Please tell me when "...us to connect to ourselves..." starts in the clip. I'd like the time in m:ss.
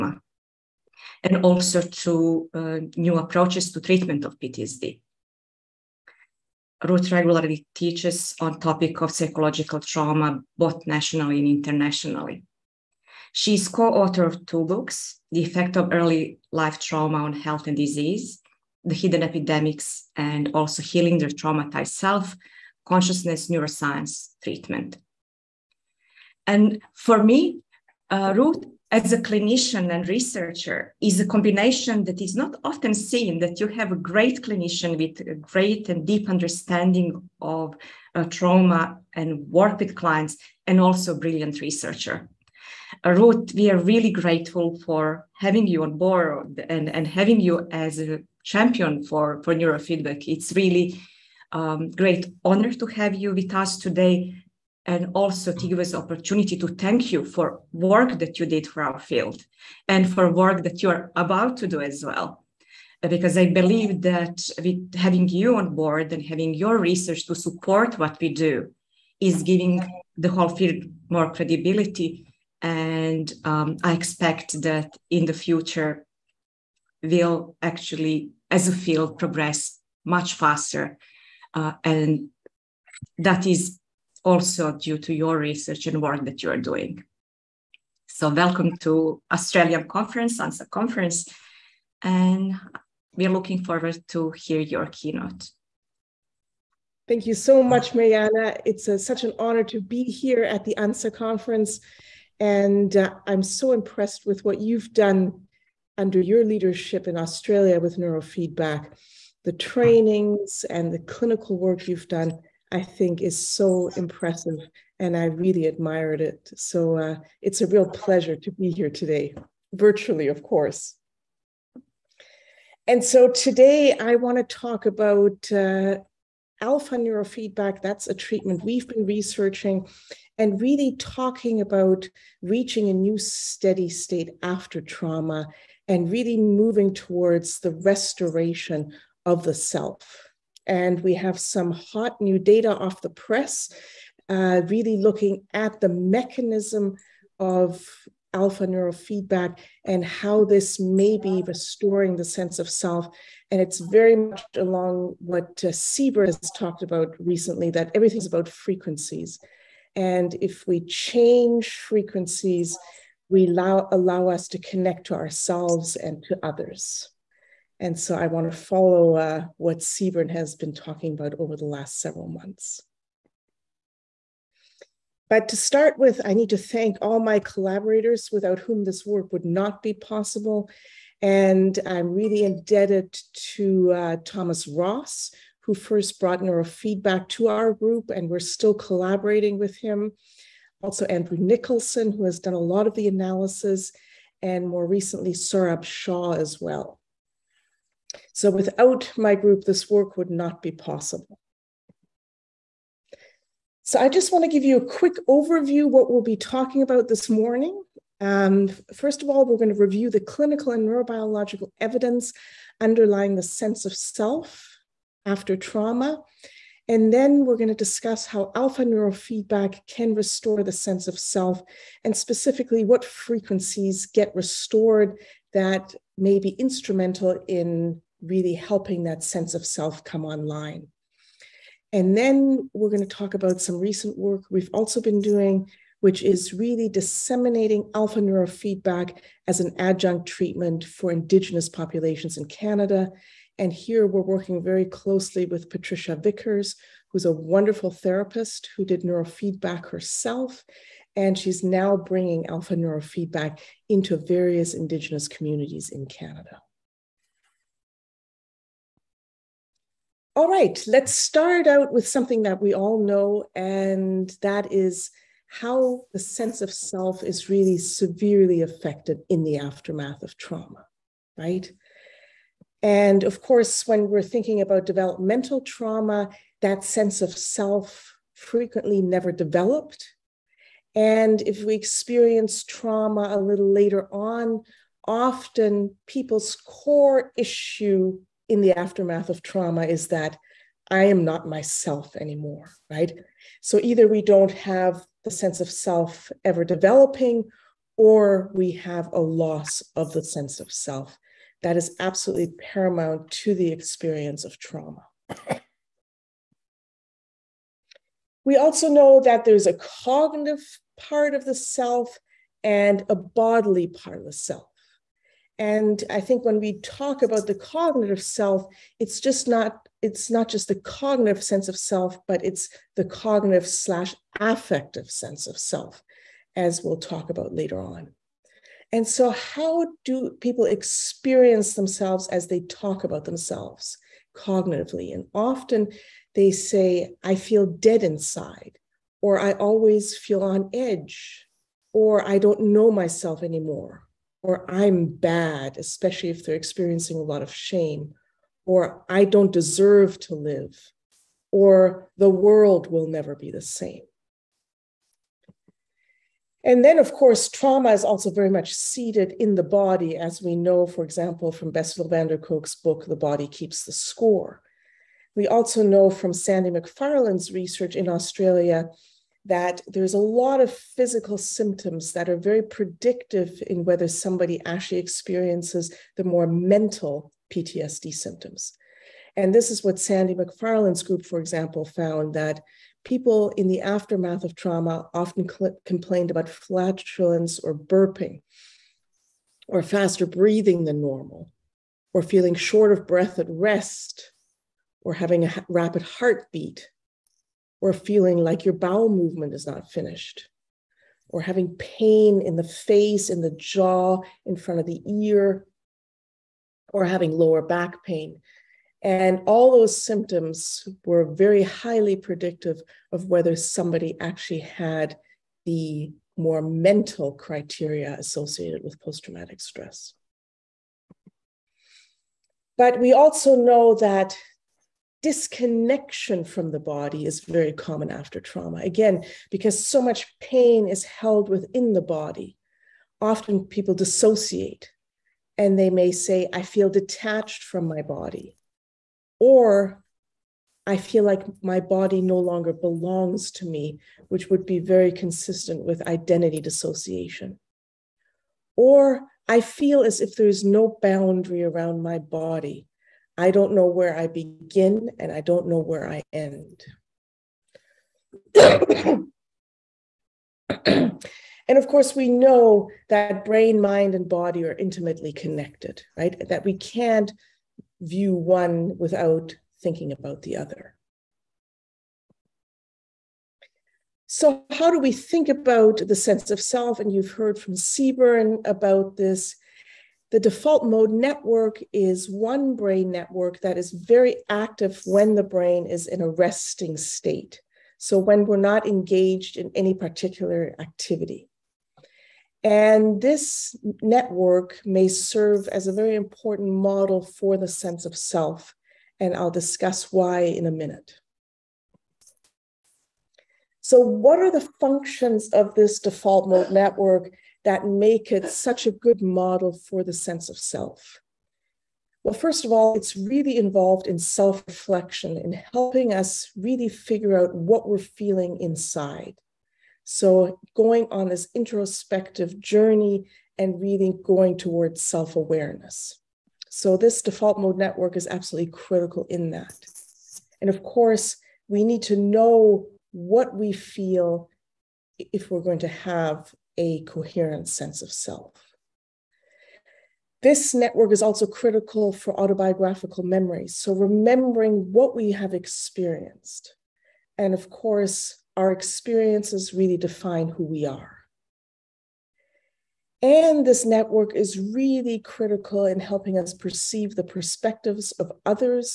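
2:44.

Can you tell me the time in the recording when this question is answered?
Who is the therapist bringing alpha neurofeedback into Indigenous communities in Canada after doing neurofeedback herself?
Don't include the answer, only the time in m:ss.
4:05.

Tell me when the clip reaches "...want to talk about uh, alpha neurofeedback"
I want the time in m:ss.
2:04.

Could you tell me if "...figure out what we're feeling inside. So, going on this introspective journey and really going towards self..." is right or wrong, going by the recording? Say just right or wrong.
right.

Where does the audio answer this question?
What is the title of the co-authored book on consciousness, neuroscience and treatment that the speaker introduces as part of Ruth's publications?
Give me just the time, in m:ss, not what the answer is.
0:20.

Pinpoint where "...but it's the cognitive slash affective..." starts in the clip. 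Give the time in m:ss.
5:22.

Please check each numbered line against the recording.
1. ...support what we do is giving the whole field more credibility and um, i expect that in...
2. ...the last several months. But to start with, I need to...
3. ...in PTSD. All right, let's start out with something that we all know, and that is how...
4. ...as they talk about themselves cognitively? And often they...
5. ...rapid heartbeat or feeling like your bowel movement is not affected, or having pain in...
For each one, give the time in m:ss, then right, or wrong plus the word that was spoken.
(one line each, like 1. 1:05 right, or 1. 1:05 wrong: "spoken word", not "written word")
1. 1:07 right
2. 2:51 right
3. 4:15 wrong: "Canada", not "PTSD"
4. 5:32 right
5. 6:35 wrong: "finished", not "affected".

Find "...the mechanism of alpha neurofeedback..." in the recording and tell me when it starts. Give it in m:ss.
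2:25.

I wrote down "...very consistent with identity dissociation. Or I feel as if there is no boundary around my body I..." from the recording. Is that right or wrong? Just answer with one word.
right.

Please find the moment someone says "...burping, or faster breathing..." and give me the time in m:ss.
6:27.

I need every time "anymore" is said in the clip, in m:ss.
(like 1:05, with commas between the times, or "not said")
4:52, 5:43.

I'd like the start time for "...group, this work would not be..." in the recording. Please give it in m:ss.
3:19.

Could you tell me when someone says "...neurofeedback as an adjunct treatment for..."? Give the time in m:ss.
3:58.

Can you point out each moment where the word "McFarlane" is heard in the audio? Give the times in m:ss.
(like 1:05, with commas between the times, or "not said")
6:06, 6:20.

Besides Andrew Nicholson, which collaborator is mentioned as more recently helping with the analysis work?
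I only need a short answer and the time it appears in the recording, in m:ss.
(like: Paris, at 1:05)
Saurabh Shaw, at 3:15.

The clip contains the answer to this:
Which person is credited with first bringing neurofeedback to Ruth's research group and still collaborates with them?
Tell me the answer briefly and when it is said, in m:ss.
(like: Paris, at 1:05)
Tomas Ros, at 3:04.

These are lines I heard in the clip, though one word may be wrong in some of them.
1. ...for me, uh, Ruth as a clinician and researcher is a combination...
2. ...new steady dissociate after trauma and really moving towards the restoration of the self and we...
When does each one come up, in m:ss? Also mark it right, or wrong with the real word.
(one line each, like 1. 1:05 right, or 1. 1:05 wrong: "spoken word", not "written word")
1. 0:26 right
2. 2:12 wrong: "state", not "dissociate".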